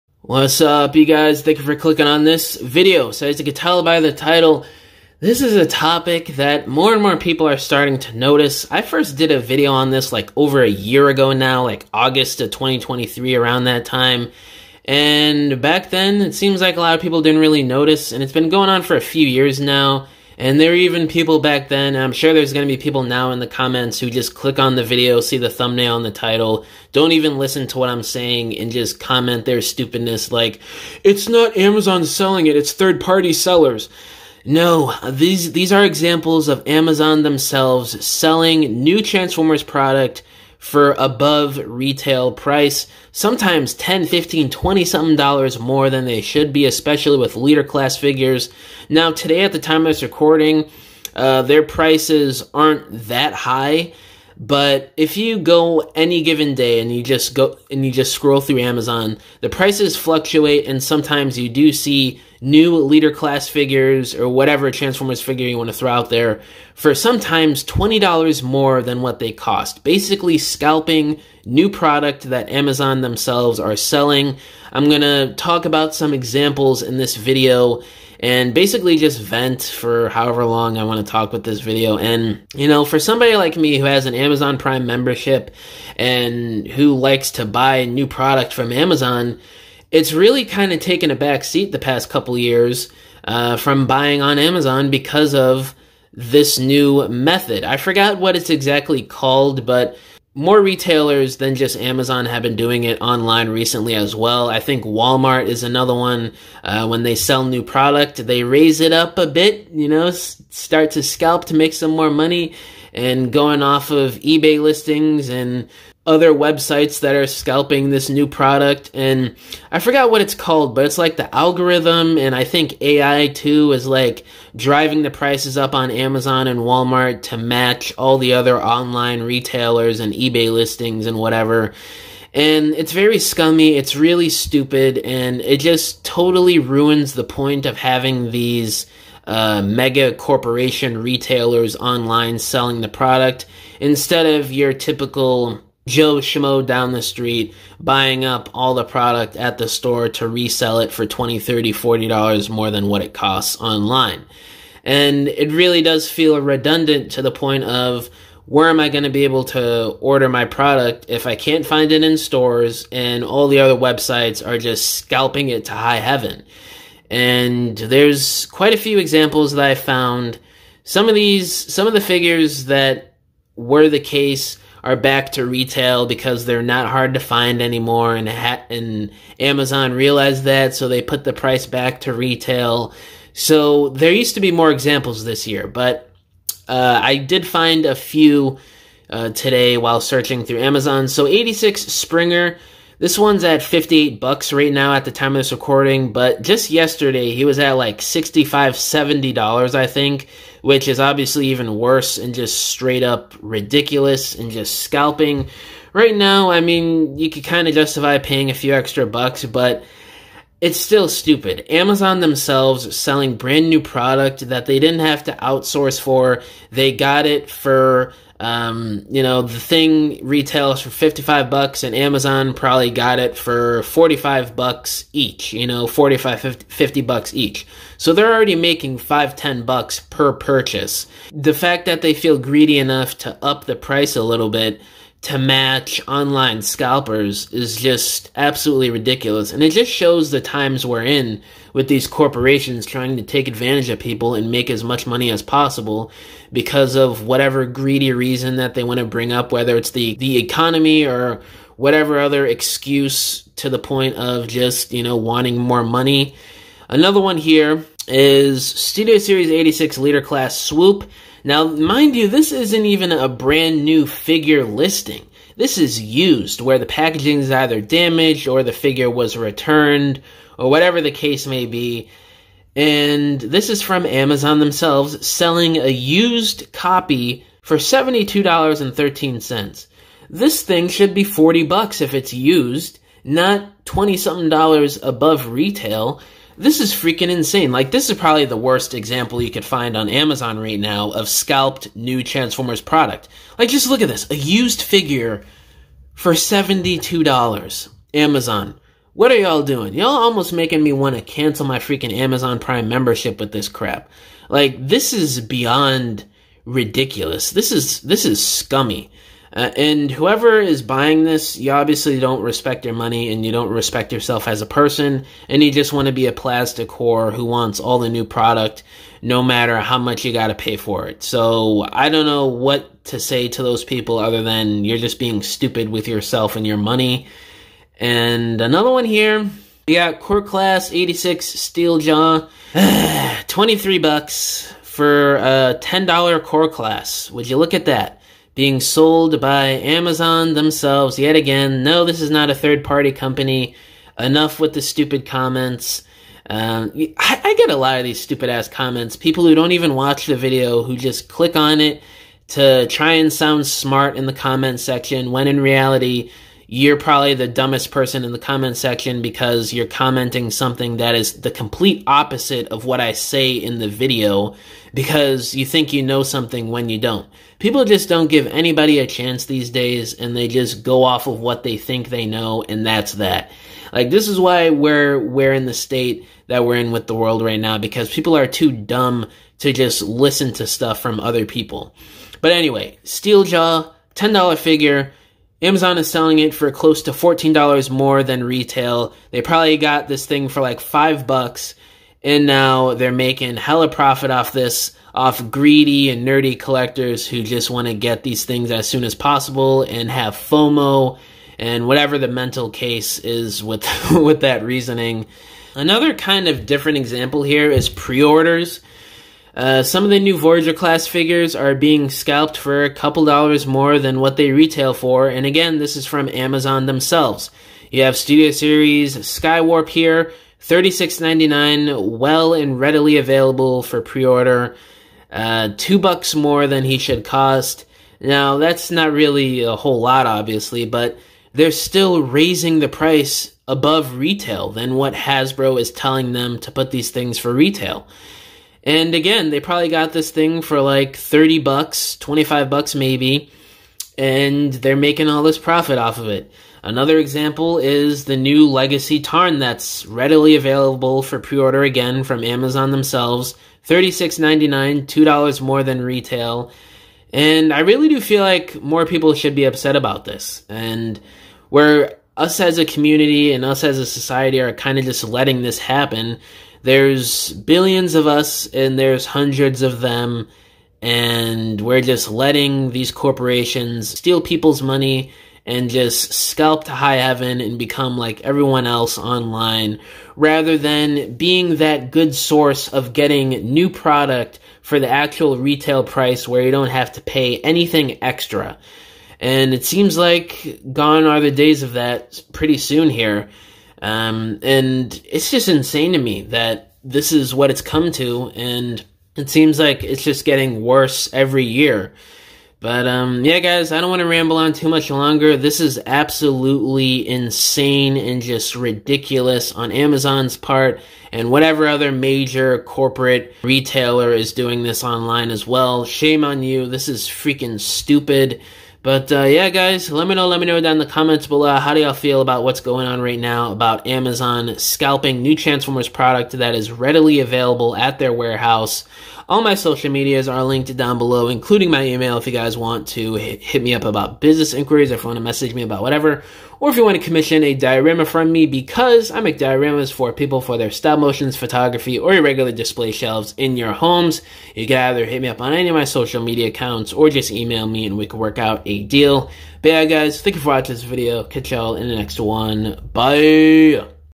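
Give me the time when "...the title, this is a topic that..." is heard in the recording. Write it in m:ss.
0:03.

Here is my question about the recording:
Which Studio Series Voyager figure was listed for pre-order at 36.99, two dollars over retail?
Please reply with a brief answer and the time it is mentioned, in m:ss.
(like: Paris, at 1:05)
Skywarp, at 6:59.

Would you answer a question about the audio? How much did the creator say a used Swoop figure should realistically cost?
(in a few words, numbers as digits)
$40.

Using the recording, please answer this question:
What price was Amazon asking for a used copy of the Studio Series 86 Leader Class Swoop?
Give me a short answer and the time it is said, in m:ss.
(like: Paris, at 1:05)
$72.13, at 4:37.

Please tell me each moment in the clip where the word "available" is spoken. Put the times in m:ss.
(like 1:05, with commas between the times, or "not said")
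7:03, 7:30, 8:47.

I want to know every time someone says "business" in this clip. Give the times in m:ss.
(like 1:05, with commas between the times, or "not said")
8:54.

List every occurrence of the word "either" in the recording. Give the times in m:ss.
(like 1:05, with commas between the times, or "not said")
4:27, 9:04.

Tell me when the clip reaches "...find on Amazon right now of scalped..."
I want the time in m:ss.
4:49.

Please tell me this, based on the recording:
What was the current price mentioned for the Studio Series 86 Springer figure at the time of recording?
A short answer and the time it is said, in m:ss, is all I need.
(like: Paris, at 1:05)
$58, at 3:13.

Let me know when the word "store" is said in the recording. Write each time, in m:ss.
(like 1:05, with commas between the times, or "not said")
2:29, 2:42.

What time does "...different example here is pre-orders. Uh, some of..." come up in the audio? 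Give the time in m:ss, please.
6:46.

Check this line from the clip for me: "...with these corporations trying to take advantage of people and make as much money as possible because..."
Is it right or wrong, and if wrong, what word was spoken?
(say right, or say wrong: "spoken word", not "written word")
right.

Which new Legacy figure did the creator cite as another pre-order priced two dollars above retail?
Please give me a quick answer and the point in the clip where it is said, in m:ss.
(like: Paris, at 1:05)
Tarn, at 7:29.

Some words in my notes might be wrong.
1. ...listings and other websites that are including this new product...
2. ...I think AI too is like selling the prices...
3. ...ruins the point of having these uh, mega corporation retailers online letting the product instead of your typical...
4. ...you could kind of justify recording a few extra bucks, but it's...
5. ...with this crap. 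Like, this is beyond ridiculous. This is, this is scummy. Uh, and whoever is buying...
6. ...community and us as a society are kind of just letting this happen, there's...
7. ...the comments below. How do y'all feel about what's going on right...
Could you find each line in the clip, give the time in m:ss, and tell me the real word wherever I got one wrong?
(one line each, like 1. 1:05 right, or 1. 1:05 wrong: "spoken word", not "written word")
1. 1:54 wrong: "scalping", not "including"
2. 2:02 wrong: "driving", not "selling"
3. 2:16 wrong: "selling", not "letting"
4. 3:27 wrong: "paying", not "recording"
5. 5:03 right
6. 7:42 right
7. 8:40 right.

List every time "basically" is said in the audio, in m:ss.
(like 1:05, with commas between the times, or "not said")
1:09, 1:18.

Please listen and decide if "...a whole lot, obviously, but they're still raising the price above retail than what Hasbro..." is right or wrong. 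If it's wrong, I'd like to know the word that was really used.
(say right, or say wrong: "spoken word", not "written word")
right.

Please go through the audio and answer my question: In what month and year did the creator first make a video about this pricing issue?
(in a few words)
August 2023.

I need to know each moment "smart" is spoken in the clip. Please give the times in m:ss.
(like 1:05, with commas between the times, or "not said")
5:53.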